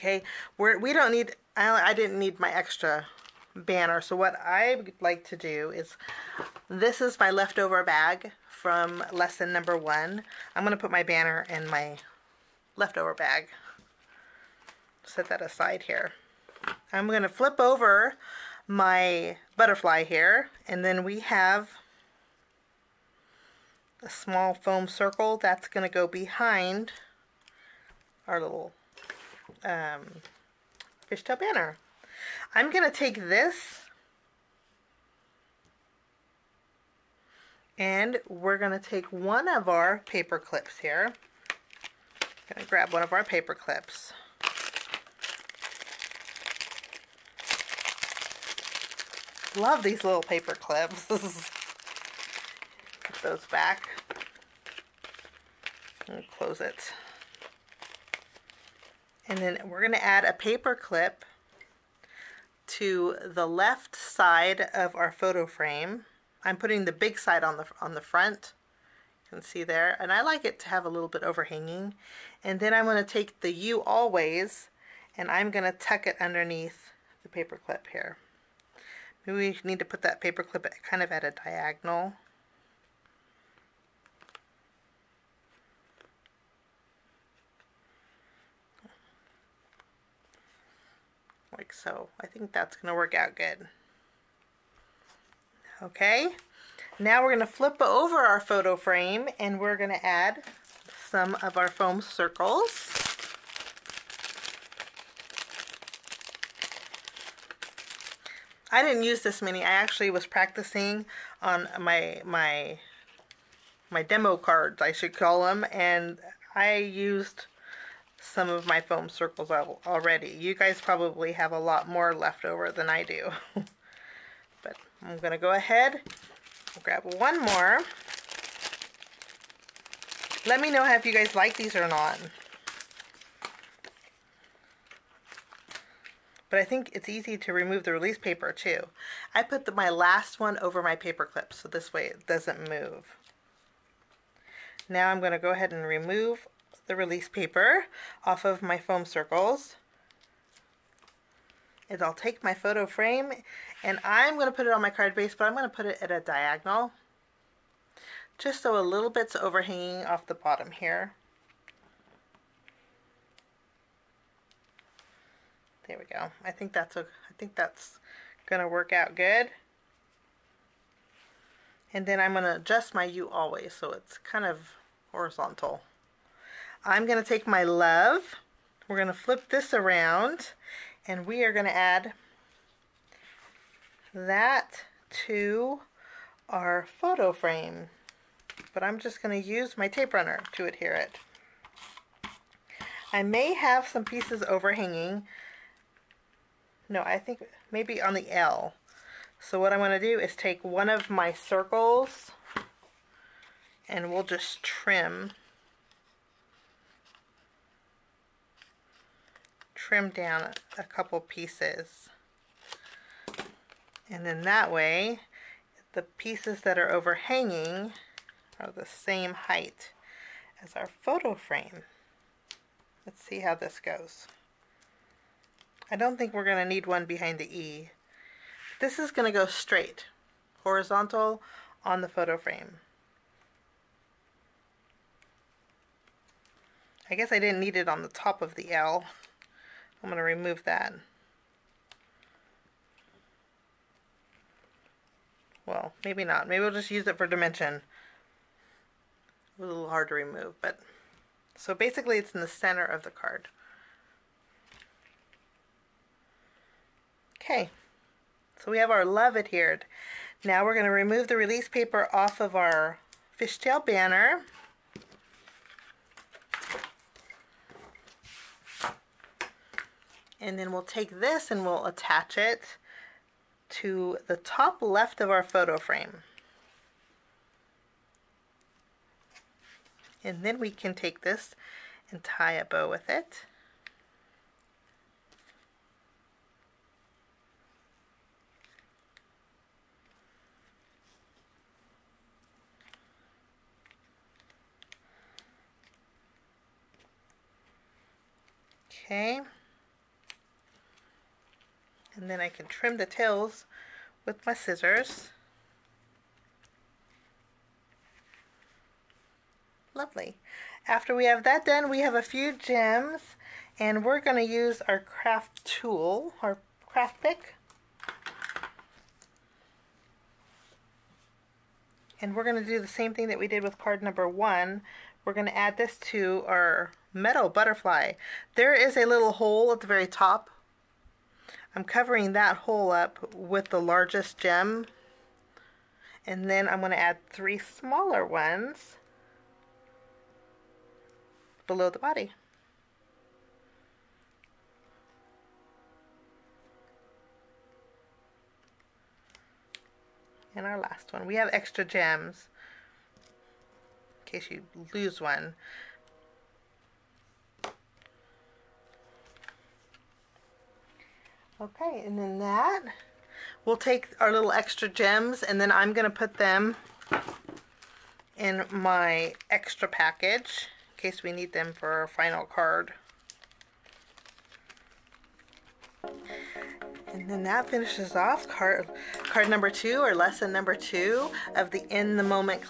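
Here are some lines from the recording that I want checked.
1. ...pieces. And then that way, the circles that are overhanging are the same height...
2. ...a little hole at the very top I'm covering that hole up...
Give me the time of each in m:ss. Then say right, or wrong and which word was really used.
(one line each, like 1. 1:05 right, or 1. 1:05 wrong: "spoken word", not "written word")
1. 3:31 wrong: "pieces", not "circles"
2. 5:28 right.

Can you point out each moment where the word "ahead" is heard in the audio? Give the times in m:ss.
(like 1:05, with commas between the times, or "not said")
2:05, 2:25.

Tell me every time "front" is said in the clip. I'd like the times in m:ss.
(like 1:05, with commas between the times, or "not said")
1:07.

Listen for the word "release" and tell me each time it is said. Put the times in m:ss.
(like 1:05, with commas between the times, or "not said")
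2:17, 2:26, 4:21.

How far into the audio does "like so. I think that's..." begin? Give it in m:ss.
1:31.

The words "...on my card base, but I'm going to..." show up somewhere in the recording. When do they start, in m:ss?
2:34.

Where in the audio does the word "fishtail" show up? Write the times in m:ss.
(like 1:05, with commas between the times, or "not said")
0:31, 4:23.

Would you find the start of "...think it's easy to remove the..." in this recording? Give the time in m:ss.
2:16.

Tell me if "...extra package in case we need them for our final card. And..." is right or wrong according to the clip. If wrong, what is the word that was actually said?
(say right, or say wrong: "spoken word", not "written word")
right.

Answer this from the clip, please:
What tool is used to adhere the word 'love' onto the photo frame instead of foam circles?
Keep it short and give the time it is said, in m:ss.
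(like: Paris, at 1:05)
tape runner, at 3:09.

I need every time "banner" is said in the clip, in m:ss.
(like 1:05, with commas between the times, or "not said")
0:03, 0:11, 0:31, 4:23.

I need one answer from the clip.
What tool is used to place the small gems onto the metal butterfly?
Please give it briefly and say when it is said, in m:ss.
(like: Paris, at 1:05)
craft pick, at 5:16.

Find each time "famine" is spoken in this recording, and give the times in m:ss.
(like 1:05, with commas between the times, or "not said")
not said.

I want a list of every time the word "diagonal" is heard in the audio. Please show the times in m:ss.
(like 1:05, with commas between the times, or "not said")
1:21, 2:36.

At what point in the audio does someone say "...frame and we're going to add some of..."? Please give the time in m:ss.
1:38.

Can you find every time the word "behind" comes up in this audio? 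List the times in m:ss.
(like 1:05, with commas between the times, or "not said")
0:26, 3:47.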